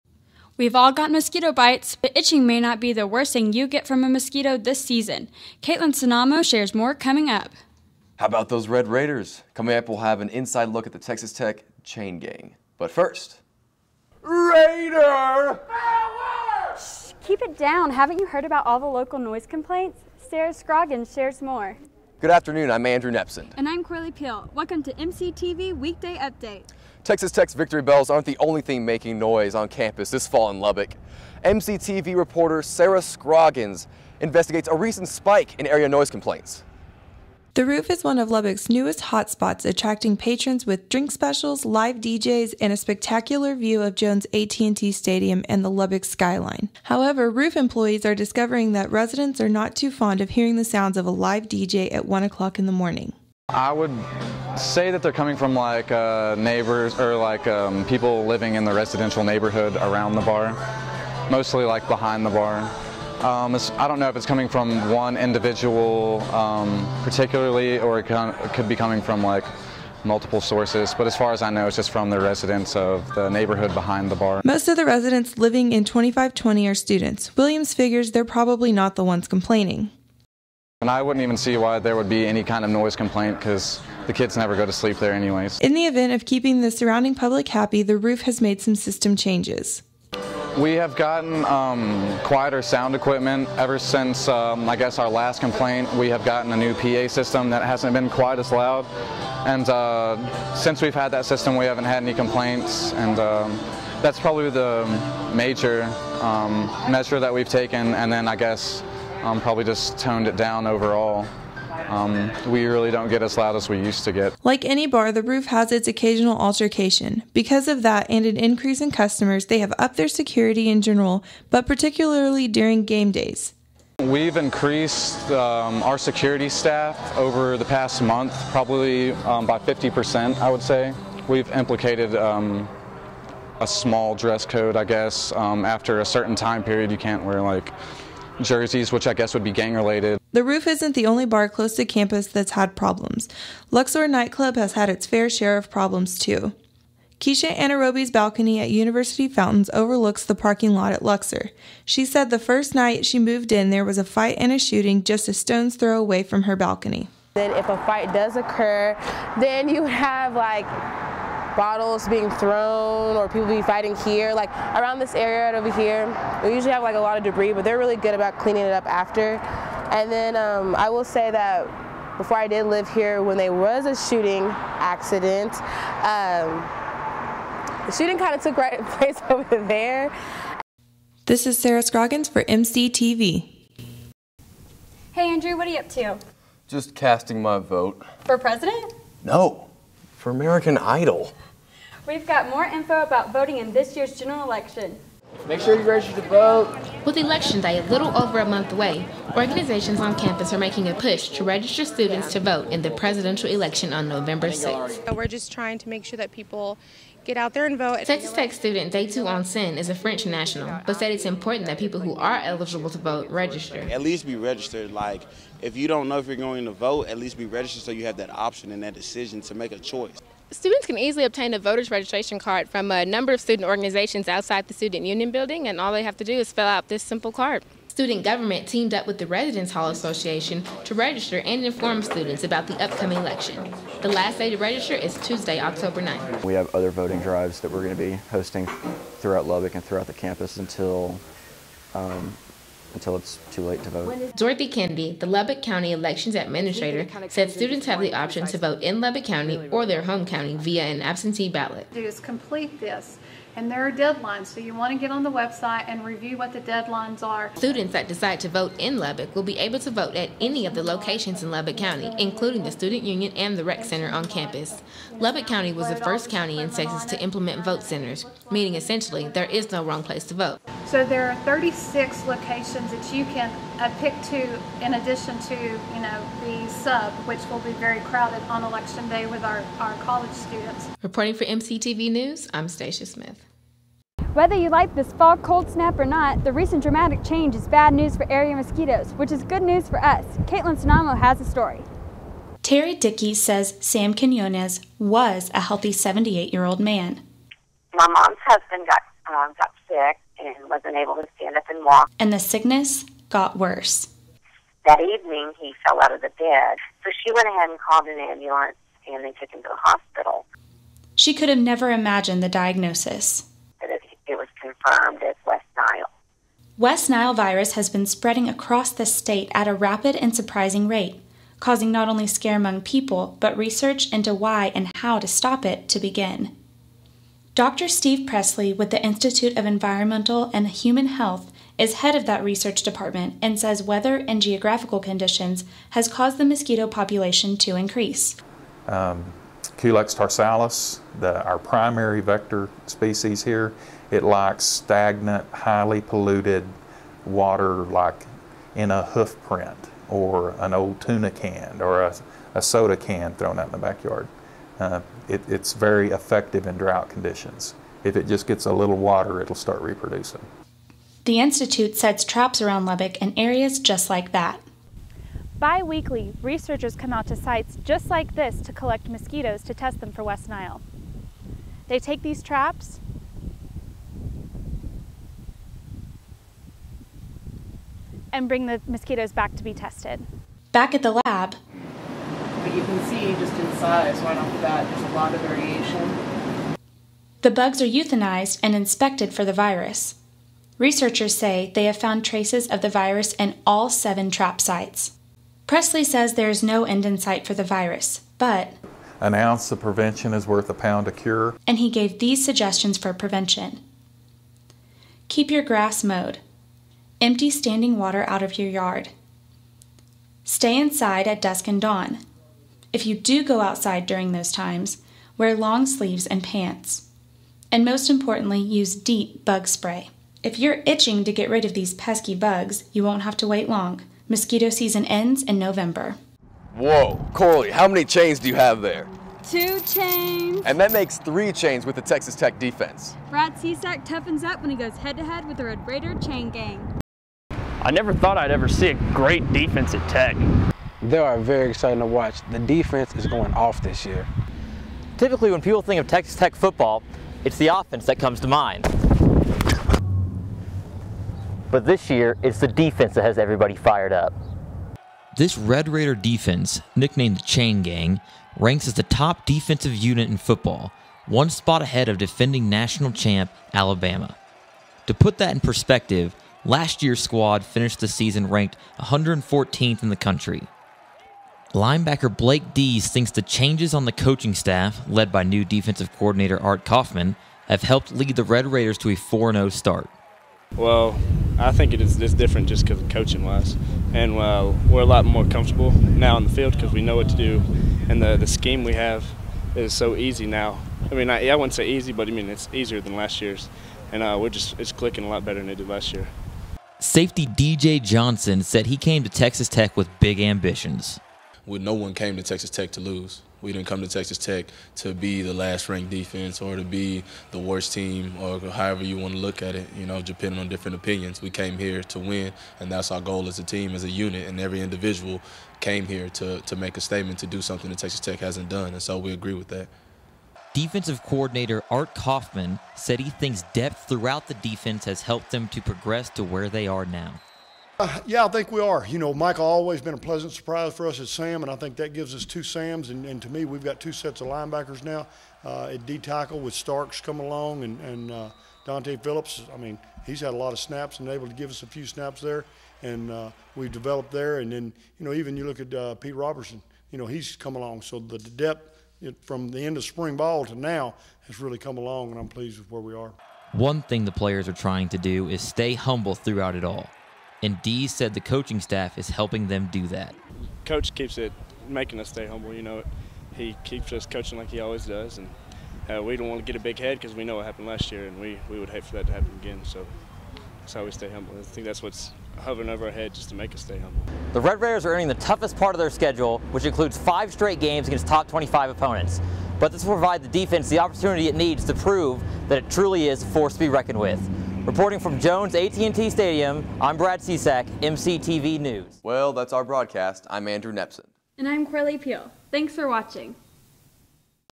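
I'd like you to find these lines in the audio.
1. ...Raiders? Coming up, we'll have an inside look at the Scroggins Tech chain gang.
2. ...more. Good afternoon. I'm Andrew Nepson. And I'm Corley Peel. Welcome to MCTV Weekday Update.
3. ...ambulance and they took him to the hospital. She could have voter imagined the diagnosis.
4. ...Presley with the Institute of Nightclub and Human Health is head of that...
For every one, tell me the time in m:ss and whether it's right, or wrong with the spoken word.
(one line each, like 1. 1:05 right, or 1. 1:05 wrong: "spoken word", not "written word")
1. 0:08 wrong: "Texas", not "Scroggins"
2. 0:21 right
3. 5:08 wrong: "never", not "voter"
4. 5:28 wrong: "Environmental", not "Nightclub".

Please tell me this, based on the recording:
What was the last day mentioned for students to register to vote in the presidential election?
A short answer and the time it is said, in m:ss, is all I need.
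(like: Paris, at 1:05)
Tuesday, October 9th, at 3:55.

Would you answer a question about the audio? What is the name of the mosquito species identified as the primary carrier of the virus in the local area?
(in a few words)
Culex tarsalis.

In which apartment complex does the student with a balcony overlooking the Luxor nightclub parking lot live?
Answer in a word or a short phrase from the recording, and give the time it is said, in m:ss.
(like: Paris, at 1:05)
University Fountains, at 2:28.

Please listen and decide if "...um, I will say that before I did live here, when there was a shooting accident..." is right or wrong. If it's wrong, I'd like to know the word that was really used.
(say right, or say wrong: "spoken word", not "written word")
right.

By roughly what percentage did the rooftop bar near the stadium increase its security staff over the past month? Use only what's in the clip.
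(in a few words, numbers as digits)
50%.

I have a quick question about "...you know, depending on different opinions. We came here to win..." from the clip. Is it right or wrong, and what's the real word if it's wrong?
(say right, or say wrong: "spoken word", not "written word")
right.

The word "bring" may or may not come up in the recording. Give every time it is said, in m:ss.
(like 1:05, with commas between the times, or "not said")
6:18.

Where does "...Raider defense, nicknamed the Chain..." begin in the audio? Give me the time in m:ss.
7:35.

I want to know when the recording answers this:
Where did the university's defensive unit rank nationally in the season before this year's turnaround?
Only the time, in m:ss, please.
7:48.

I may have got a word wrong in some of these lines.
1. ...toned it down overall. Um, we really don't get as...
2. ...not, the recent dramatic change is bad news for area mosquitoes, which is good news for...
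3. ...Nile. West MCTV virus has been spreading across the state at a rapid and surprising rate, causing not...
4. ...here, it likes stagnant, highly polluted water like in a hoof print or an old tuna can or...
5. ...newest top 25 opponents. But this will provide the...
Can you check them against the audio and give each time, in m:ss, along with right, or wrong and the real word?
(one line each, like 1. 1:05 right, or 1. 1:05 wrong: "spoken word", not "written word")
1. 1:49 right
2. 4:46 right
3. 5:15 wrong: "Nile", not "MCTV"
4. 5:43 right
5. 9:38 wrong: "against", not "newest".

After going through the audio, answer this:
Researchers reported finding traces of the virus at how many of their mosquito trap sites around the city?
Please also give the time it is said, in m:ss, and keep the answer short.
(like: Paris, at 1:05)
7, at 6:33.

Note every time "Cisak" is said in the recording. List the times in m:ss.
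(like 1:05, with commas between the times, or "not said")
7:13, 9:47.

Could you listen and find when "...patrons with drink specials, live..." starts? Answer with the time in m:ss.
0:40.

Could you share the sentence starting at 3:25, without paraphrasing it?
we're just trying to make sure that people get out there and vote.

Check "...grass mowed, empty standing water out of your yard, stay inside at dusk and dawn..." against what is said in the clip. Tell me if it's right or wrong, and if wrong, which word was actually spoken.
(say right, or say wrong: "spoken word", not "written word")
right.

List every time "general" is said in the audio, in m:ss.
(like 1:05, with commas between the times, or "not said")
2:00, 3:14.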